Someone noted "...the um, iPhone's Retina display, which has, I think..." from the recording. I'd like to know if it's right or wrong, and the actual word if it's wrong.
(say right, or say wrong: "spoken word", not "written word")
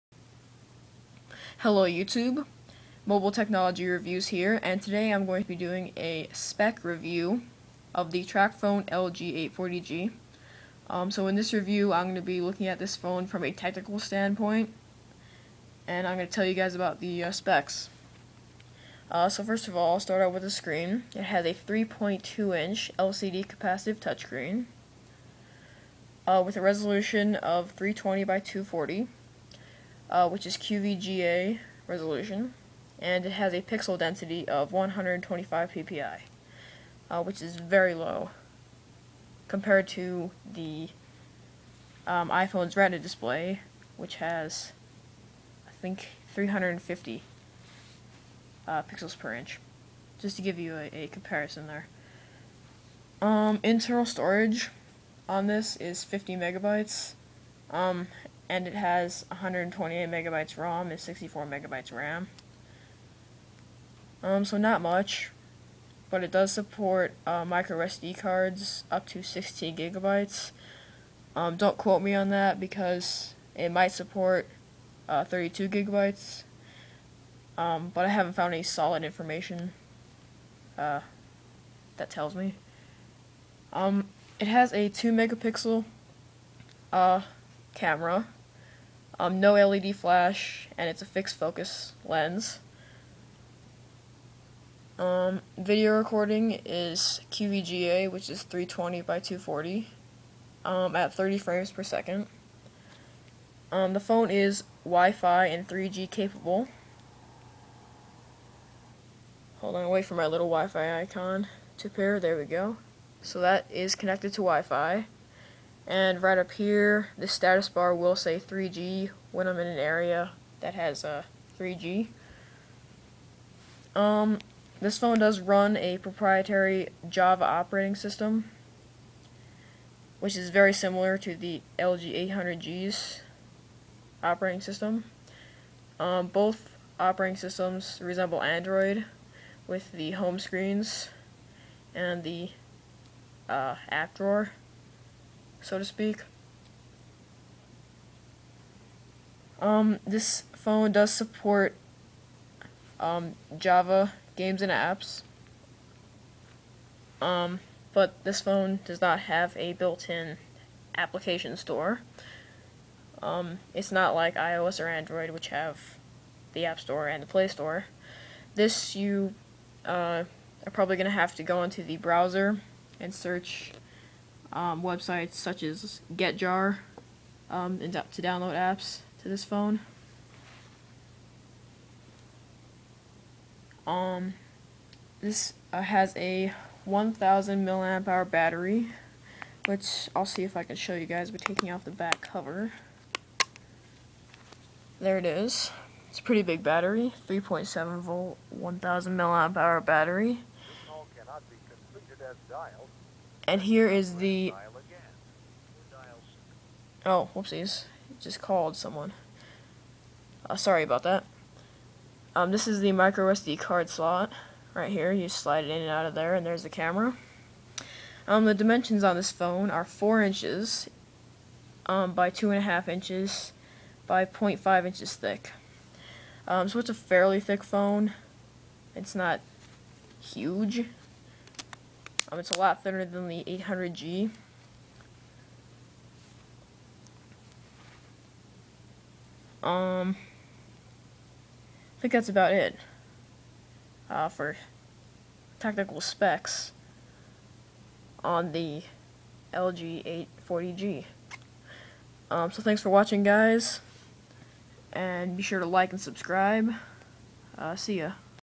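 right.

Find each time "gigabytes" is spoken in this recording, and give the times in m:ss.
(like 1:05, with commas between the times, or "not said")
1:09, 1:15.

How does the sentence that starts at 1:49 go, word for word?
Hold on, wait for my little Wi-Fi icon to pair.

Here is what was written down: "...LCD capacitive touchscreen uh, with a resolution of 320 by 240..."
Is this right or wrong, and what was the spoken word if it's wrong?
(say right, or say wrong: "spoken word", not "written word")
right.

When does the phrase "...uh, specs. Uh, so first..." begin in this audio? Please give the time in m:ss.
0:17.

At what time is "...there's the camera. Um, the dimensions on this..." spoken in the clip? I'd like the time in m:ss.
3:36.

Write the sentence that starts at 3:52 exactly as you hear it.
Um, it's a lot thinner than the 800G.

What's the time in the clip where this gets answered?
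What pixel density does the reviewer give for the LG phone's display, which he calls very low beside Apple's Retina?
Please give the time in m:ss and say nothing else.
0:34.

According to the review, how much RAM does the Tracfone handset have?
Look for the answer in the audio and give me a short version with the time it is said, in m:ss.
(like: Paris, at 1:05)
64 megabytes, at 1:00.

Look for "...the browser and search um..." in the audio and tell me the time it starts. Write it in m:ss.
2:51.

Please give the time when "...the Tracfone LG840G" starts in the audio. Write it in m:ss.
0:08.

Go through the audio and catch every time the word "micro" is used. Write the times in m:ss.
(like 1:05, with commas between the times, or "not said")
1:07, 3:32.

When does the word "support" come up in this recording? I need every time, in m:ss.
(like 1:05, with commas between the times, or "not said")
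1:06, 1:13, 2:31.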